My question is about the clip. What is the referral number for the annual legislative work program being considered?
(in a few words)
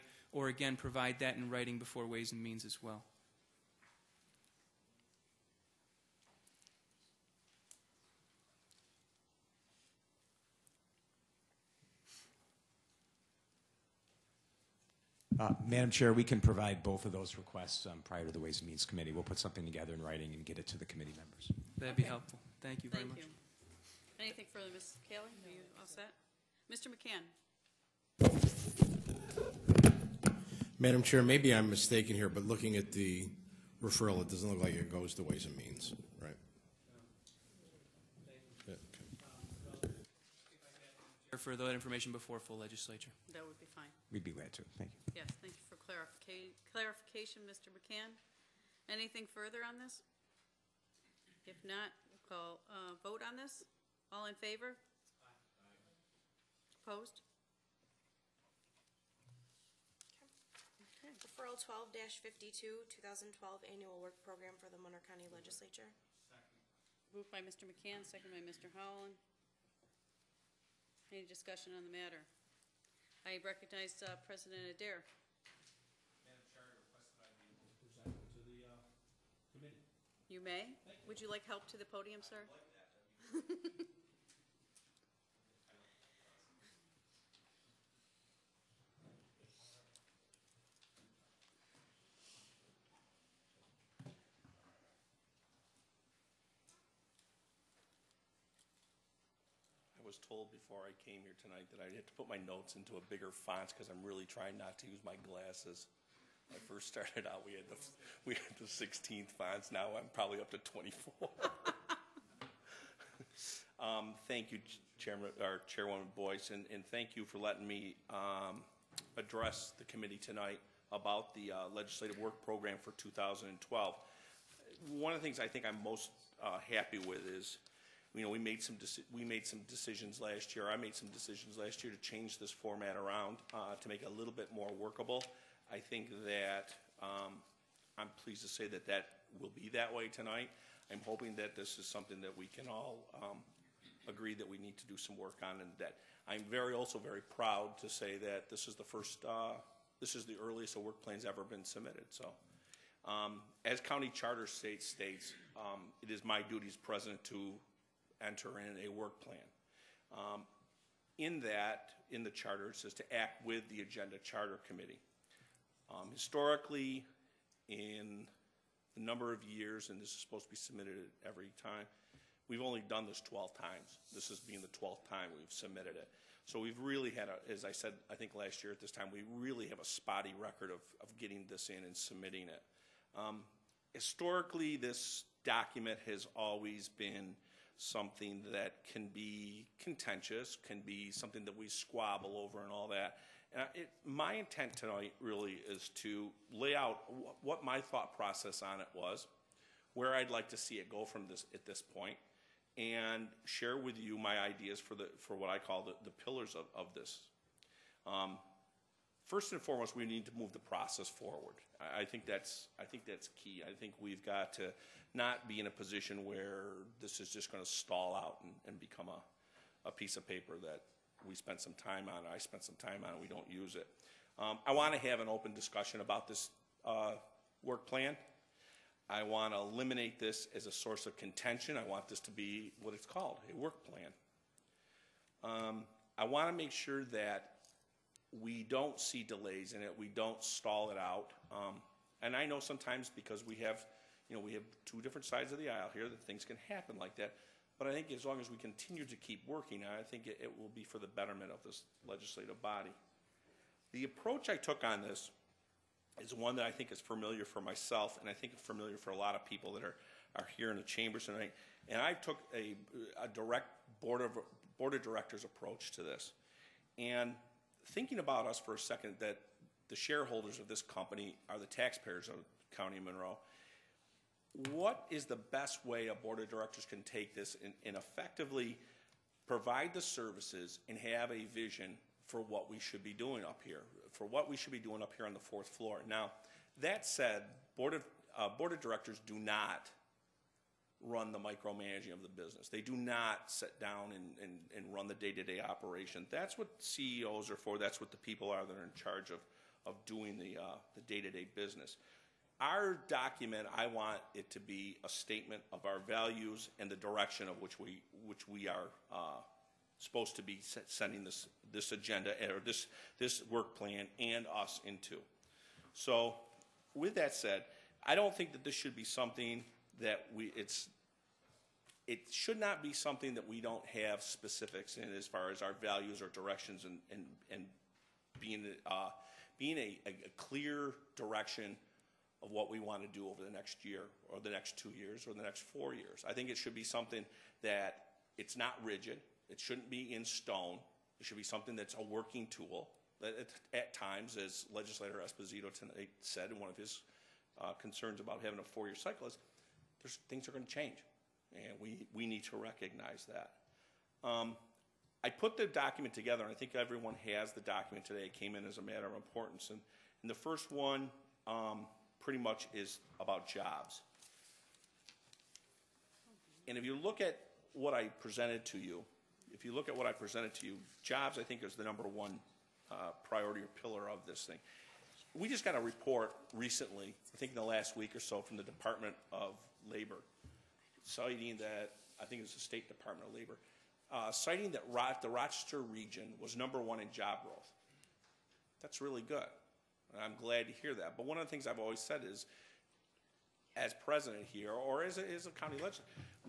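1252.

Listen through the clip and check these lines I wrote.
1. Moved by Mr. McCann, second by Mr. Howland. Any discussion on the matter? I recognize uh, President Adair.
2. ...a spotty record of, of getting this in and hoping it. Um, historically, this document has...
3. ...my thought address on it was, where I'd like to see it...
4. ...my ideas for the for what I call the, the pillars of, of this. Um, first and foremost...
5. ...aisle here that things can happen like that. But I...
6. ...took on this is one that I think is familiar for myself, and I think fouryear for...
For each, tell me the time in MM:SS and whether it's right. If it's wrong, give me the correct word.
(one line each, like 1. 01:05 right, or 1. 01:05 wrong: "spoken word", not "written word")
1. 01:07 right
2. 02:59 wrong: "submitting", not "hoping"
3. 03:17 wrong: "process", not "address"
4. 03:24 right
5. 04:05 right
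6. 04:14 wrong: "familiar", not "fouryear".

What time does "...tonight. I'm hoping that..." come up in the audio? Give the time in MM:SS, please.
02:20.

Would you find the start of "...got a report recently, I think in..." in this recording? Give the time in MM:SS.
06:15.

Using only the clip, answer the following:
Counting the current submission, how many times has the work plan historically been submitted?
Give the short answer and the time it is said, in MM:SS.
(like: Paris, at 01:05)
12, at 02:54.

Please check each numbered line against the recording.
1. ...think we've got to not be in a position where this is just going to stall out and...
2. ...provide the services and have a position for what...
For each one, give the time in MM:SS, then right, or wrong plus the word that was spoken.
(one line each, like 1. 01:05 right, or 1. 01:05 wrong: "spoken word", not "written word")
1. 03:33 right
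2. 04:39 wrong: "vision", not "position".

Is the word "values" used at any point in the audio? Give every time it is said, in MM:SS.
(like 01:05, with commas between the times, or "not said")
05:06, 05:25.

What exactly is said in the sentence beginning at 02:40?
Um, in that, in the charter, it says to act with the agenda charter committee.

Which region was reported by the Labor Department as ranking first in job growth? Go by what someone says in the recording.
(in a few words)
Rochester.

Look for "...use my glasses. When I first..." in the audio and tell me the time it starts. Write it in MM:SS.
01:44.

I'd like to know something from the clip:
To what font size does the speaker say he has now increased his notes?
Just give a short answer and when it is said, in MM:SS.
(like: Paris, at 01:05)
24, at 01:50.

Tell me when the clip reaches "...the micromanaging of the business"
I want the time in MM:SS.
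04:51.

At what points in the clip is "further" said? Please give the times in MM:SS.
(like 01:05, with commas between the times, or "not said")
00:24, 00:49.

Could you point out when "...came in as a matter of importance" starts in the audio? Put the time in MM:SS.
05:58.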